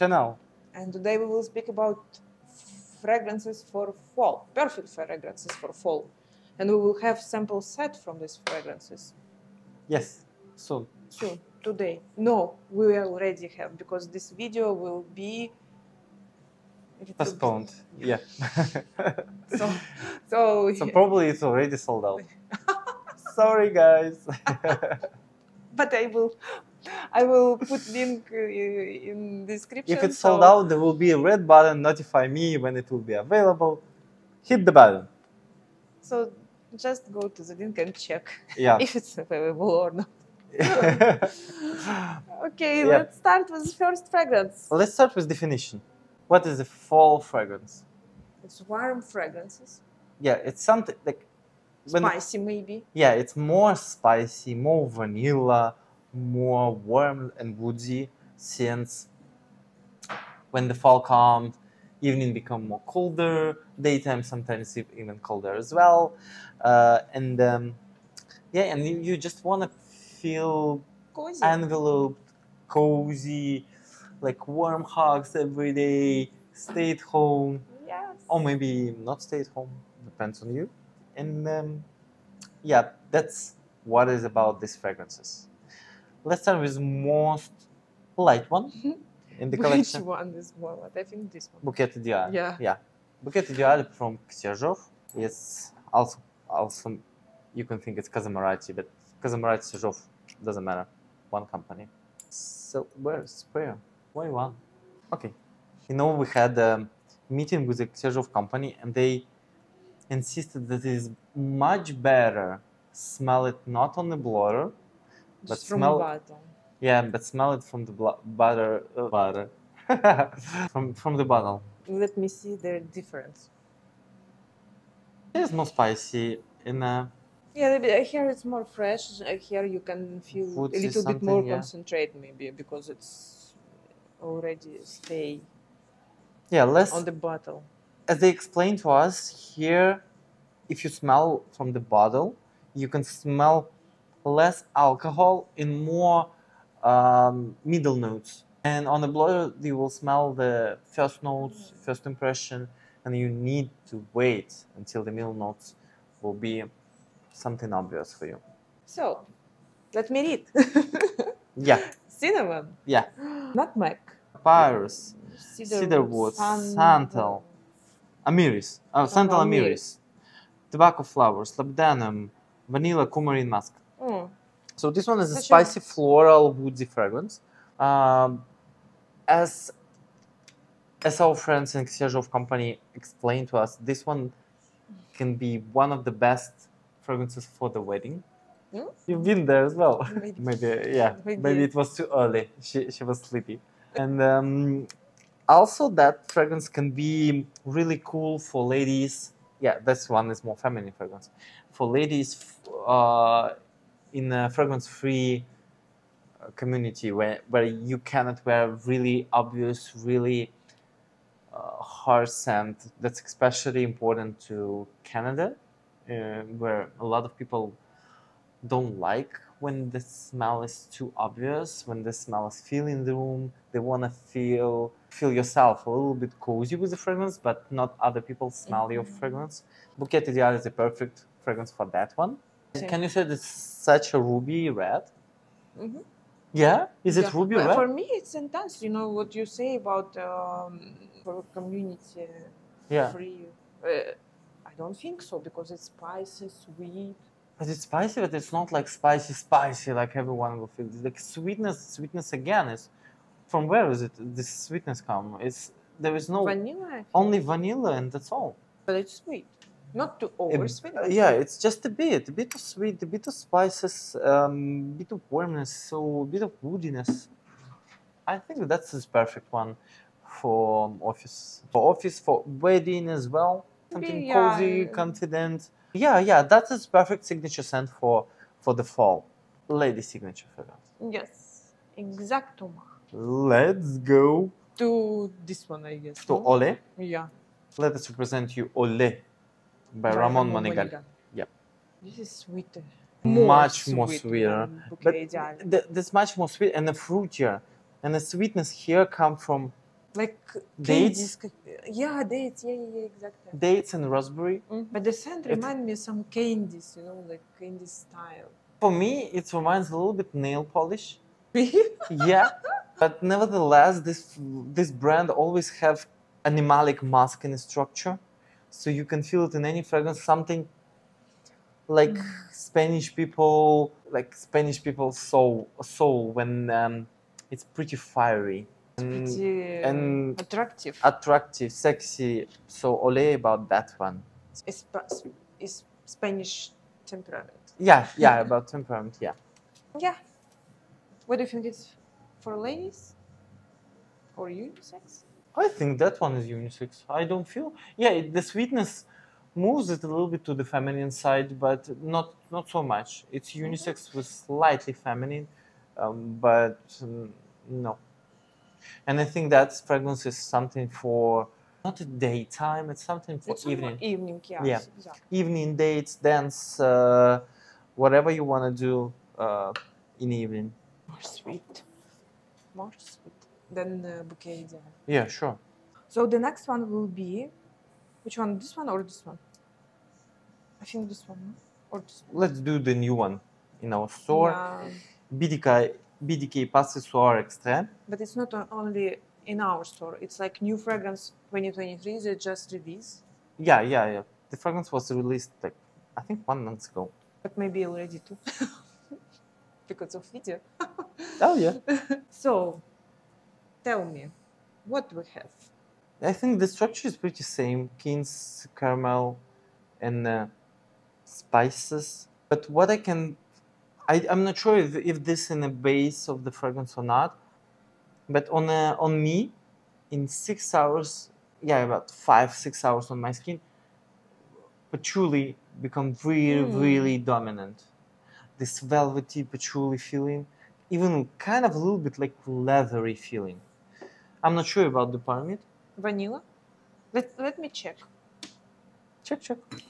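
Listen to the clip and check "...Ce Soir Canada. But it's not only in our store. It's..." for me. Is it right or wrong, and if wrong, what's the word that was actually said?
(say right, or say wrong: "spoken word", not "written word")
wrong: "Extrait", not "Canada".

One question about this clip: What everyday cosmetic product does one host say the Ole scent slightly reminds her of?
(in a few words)
Nail polish.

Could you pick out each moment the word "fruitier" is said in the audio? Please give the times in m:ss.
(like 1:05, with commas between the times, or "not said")
4:56.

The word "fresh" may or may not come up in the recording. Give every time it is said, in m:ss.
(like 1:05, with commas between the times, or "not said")
2:08.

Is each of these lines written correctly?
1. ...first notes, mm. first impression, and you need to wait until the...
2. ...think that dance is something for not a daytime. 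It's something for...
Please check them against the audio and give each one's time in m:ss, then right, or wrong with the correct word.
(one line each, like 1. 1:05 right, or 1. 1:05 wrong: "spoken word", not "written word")
1. 2:30 right
2. 5:59 wrong: "fragrance", not "dance".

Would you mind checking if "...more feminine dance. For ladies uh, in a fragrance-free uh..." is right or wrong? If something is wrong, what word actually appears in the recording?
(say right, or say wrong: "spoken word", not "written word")
wrong: "fragrance", not "dance".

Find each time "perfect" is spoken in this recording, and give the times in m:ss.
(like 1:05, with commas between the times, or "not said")
0:04, 3:50, 4:29, 4:36.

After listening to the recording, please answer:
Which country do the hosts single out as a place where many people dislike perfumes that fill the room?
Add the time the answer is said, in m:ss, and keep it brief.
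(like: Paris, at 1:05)
Canada, at 3:35.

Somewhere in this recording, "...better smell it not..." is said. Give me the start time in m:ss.
1:52.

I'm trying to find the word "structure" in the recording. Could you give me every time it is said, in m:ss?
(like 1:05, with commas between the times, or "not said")
5:17, 6:46.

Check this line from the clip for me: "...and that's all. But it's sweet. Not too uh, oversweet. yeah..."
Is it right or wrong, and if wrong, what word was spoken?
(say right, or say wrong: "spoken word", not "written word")
right.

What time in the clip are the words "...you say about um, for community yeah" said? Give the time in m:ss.
3:59.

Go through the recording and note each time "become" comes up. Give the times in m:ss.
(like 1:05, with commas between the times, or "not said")
1:02, 7:05.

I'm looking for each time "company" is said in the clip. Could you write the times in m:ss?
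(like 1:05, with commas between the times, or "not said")
1:41, 1:48, 3:02.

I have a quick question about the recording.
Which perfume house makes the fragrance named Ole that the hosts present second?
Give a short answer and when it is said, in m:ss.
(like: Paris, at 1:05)
Ramon Monegal, at 4:50.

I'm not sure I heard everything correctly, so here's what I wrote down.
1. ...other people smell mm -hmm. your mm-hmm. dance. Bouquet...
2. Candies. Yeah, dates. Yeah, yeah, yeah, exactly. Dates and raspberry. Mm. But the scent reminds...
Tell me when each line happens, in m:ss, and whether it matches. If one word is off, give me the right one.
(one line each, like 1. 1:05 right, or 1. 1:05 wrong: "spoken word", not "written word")
1. 3:48 wrong: "fragrance", not "dance"
2. 5:01 right.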